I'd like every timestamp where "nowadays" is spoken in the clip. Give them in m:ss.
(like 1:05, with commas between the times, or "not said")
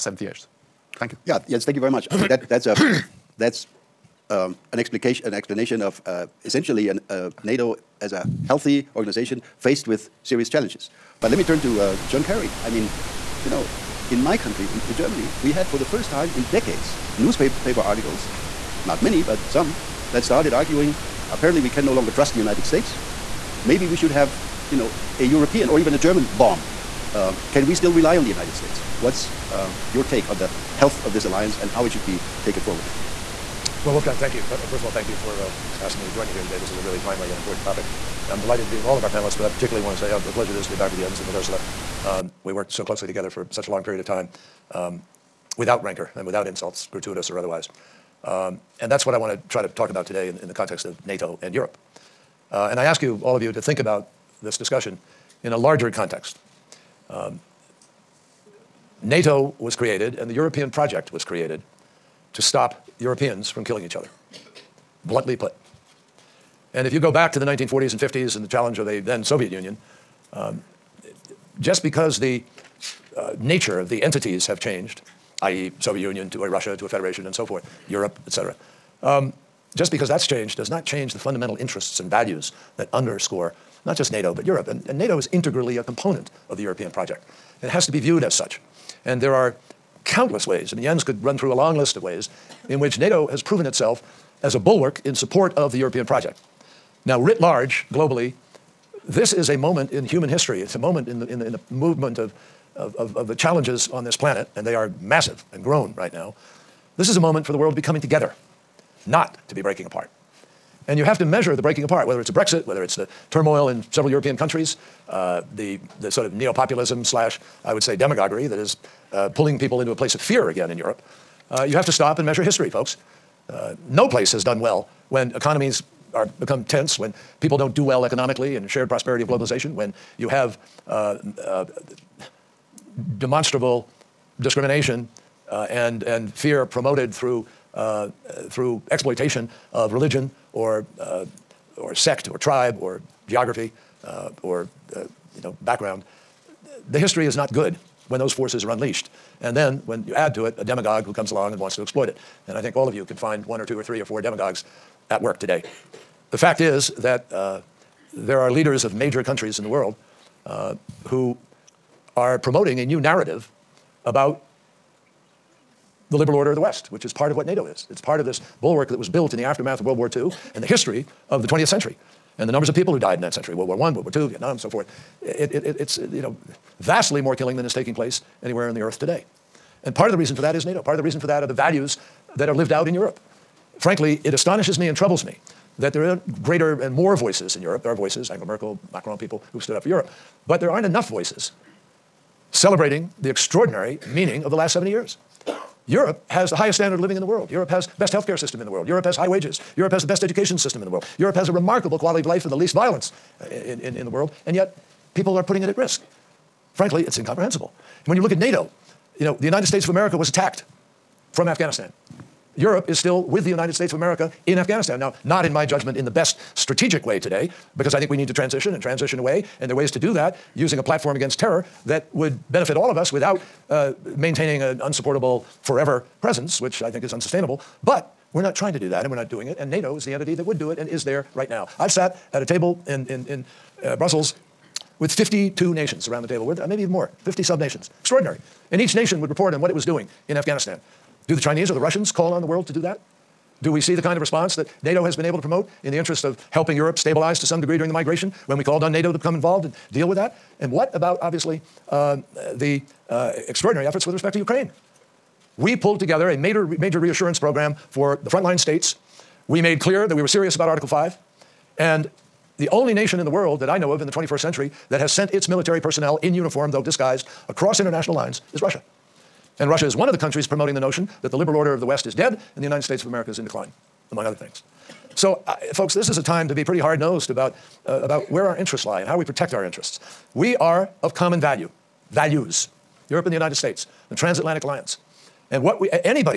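not said.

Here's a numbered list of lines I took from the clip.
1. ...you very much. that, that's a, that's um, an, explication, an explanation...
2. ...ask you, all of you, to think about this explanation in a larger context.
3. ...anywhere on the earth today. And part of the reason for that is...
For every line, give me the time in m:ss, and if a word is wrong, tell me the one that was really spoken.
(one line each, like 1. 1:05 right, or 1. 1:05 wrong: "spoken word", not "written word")
1. 0:01 right
2. 0:52 wrong: "discussion", not "explanation"
3. 2:58 right.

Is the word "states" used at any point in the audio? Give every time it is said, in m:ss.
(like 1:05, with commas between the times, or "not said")
0:22, 0:28, 3:29, 3:33, 4:18, 4:32, 4:43.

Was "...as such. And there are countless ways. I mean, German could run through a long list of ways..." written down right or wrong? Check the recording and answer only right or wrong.
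wrong.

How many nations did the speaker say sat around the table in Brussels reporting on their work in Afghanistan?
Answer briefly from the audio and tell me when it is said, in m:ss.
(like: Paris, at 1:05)
52, at 3:55.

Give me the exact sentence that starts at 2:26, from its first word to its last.
The history is not good when those forces are unleashed.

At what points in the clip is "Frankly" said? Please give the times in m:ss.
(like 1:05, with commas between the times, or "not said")
3:03, 3:26.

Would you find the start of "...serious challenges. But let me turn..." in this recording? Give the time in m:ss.
0:10.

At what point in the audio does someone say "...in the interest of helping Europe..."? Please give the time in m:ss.
4:05.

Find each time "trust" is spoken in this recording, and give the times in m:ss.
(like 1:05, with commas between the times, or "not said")
0:22.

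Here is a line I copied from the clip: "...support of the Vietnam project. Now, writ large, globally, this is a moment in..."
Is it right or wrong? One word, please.
wrong.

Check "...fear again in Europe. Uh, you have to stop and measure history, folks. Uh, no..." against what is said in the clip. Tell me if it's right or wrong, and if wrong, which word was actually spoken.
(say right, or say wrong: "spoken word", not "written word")
right.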